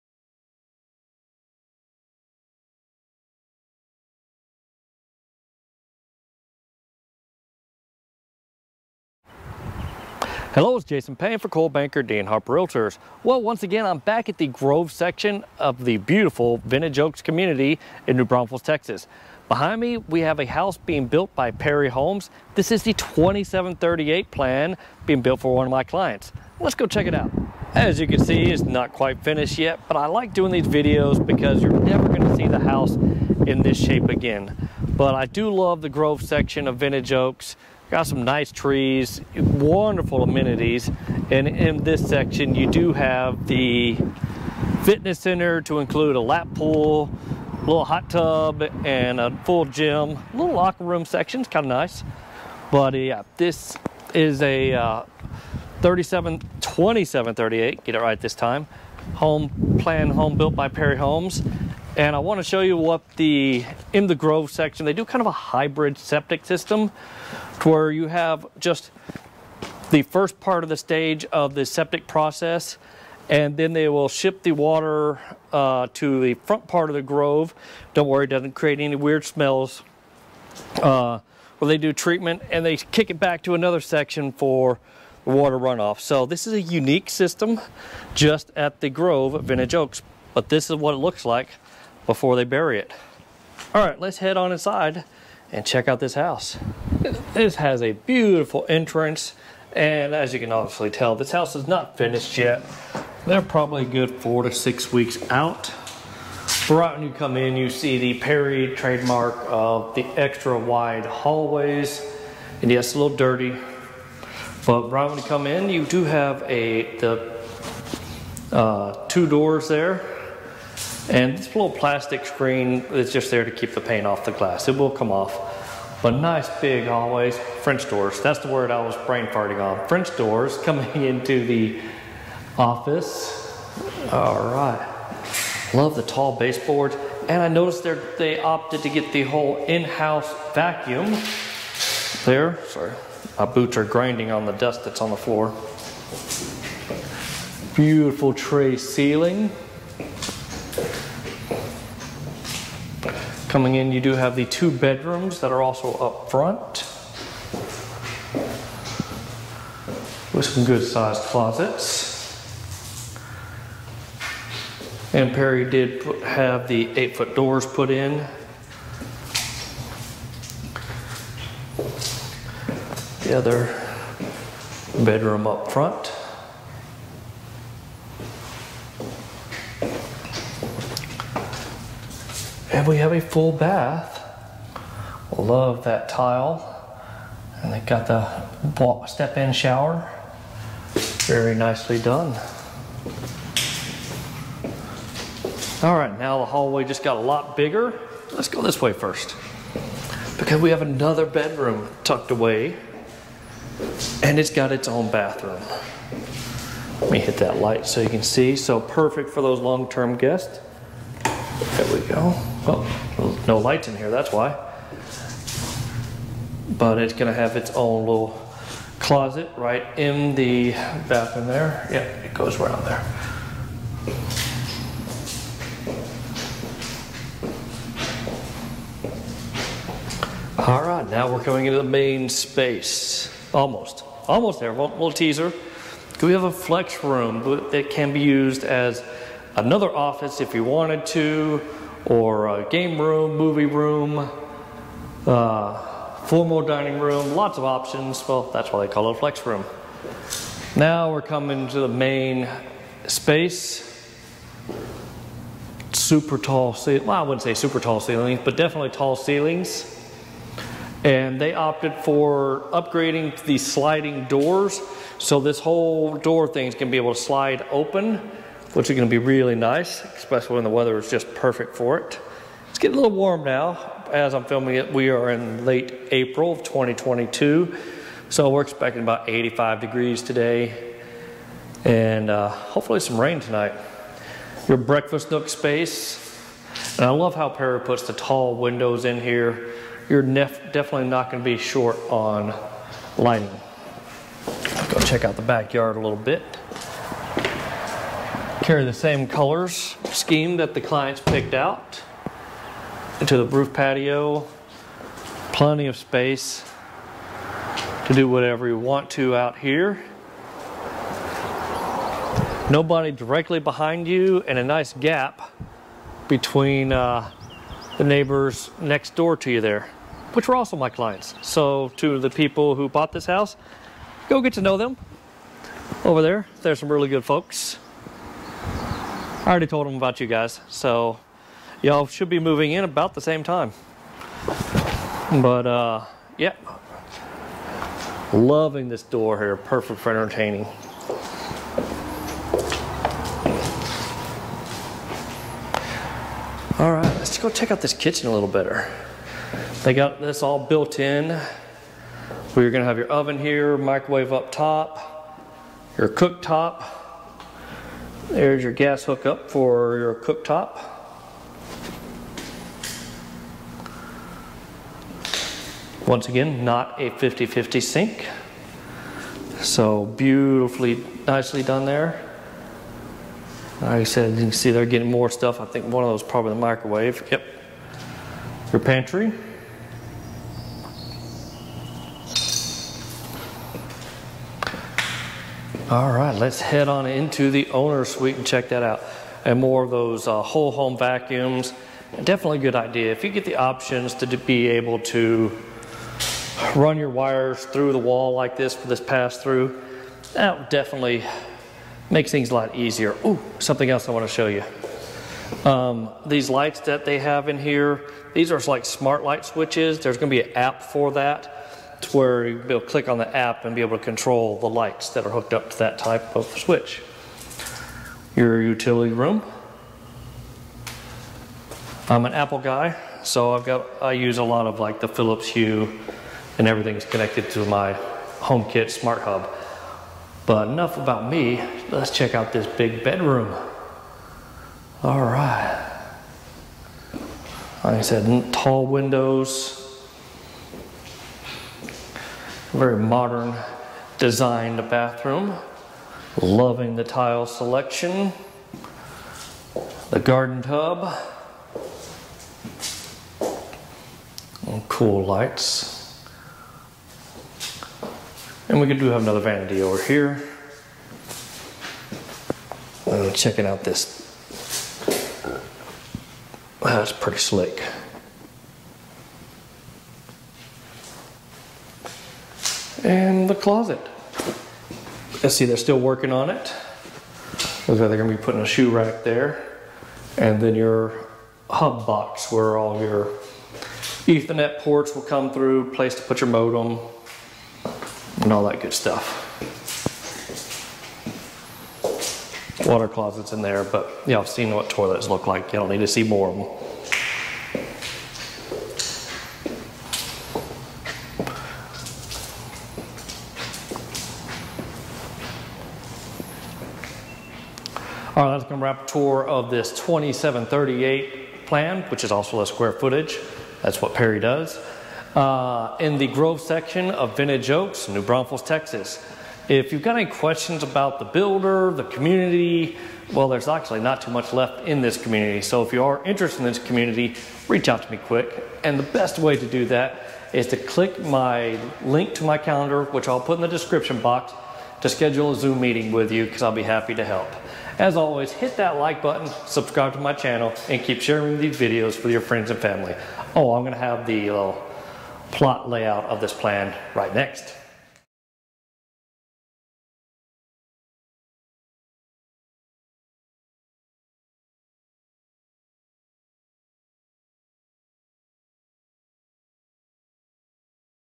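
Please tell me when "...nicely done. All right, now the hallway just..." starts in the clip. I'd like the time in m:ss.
3:11.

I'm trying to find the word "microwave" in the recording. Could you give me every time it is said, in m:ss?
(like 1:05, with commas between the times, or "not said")
5:53, 6:16.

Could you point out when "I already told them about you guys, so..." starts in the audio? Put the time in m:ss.
5:29.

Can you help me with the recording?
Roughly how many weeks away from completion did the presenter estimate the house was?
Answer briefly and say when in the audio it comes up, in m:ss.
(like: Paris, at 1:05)
4 to 6 weeks, at 1:44.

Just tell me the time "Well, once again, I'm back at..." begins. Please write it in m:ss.
0:13.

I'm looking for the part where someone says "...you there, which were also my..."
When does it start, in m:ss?
5:19.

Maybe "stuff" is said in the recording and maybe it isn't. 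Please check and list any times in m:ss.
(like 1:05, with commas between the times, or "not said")
6:15, 8:08.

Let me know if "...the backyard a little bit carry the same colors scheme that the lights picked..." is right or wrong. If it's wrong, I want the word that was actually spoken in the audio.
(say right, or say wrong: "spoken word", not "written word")
wrong: "clients", not "lights".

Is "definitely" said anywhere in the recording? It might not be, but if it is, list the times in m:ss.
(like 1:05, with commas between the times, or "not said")
4:18, 4:50, 6:32, 6:40.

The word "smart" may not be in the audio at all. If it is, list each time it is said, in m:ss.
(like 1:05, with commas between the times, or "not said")
6:48, 7:08.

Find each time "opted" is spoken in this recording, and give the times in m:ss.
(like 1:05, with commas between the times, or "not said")
2:18, 4:21.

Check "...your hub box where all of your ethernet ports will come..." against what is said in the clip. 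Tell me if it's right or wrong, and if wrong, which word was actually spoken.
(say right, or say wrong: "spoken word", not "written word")
right.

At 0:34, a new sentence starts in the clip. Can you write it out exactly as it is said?
But I do love the Grove section of Vintage Oaks.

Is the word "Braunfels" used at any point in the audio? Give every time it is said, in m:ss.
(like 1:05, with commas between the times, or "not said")
0:18, 8:38.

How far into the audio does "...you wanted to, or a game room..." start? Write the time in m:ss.
4:00.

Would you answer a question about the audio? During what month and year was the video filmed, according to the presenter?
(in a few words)
April 2022.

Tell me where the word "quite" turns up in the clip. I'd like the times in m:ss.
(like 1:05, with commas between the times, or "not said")
0:28.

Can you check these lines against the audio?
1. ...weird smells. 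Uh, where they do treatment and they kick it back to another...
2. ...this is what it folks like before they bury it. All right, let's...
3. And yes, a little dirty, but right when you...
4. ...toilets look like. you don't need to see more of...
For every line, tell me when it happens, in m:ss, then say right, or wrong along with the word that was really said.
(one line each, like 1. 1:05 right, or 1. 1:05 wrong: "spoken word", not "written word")
1. 1:18 right
2. 1:30 wrong: "looks", not "folks"
3. 1:52 right
4. 8:14 right.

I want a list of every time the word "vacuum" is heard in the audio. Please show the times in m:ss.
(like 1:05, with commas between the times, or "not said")
2:20, 6:30.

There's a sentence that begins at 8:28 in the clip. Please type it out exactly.
wrap tour of this 2738 plan, which is also the square footage.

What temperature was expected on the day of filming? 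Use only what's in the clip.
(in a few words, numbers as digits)
85 degrees.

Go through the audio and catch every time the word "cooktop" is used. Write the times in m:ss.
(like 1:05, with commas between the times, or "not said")
5:56, 6:00.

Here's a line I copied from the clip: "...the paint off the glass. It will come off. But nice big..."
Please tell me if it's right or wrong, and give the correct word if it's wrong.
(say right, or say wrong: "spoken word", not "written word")
right.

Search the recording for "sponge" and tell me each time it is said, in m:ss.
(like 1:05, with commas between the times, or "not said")
not said.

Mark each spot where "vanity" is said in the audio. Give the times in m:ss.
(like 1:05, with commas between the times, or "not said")
7:39.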